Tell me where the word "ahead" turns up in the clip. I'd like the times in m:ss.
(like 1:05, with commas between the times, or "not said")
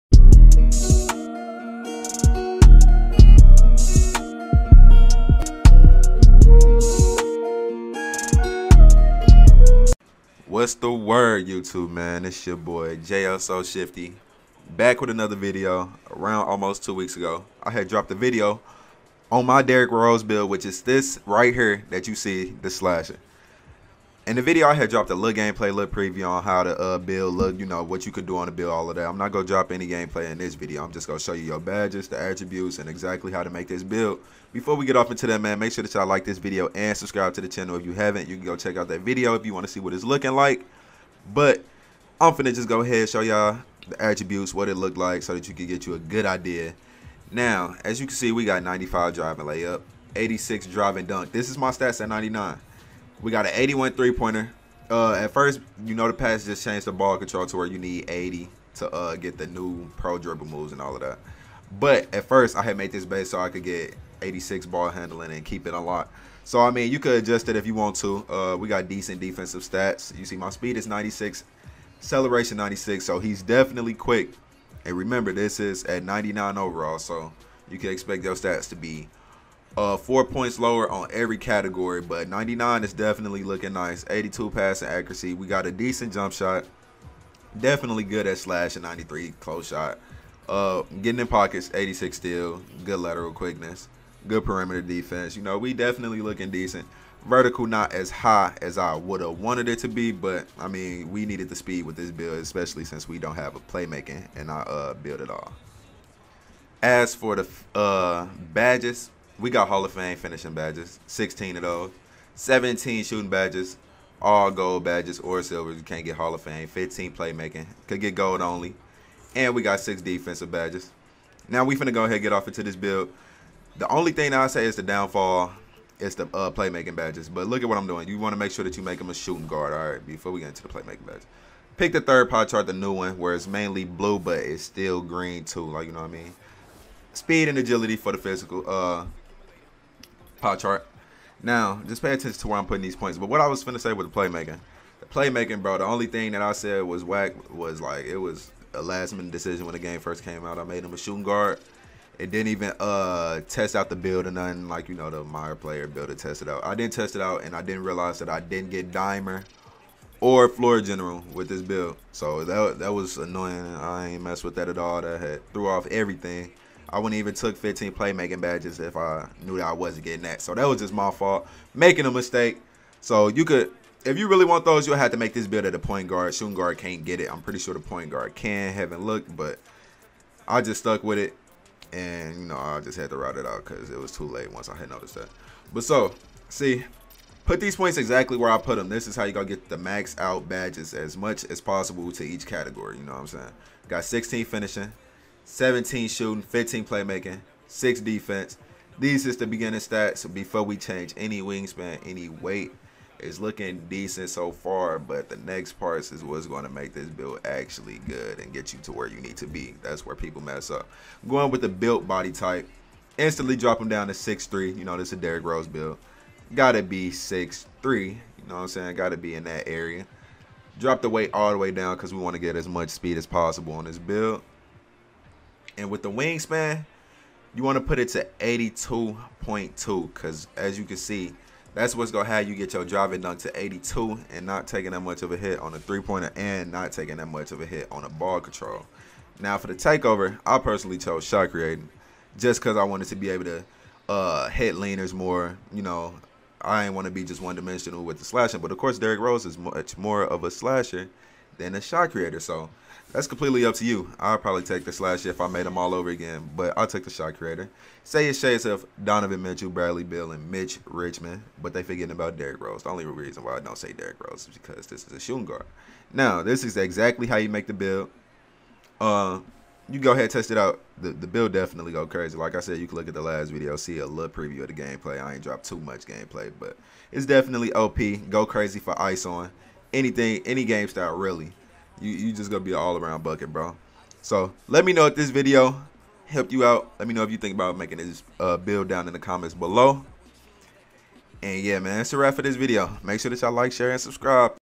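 0:42, 2:02, 4:30.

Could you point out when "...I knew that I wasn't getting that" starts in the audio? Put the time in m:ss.
2:48.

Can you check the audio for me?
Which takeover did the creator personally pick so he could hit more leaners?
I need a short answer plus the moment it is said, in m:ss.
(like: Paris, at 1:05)
Shot creating, at 4:01.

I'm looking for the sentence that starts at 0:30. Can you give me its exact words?
I'm just going to show you your badges, the attributes, and exactly how to make this build.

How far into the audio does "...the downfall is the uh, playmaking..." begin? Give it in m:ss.
2:04.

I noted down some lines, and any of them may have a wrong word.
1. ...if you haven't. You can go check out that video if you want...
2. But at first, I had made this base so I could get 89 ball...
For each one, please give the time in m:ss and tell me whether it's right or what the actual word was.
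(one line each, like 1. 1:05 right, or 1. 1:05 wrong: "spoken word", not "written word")
1. 0:37 right
2. 1:01 wrong: "86", not "89".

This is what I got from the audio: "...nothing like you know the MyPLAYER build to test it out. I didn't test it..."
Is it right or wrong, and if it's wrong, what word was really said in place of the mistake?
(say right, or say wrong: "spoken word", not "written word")
right.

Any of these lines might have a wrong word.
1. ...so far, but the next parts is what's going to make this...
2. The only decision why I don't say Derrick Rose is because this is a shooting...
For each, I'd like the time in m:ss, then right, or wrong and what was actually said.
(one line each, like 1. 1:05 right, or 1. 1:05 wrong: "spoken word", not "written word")
1. 3:24 right
2. 4:22 wrong: "reason", not "decision".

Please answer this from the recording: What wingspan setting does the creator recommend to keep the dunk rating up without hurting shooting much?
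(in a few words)
82.2.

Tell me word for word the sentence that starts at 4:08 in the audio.
But of course, Derrick Rose is much more of a slasher than a shot creator.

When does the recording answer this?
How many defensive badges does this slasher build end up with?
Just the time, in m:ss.
1:59.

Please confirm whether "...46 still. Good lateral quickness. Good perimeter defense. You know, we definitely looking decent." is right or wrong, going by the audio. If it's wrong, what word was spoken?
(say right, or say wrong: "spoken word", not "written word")
wrong: "86", not "46".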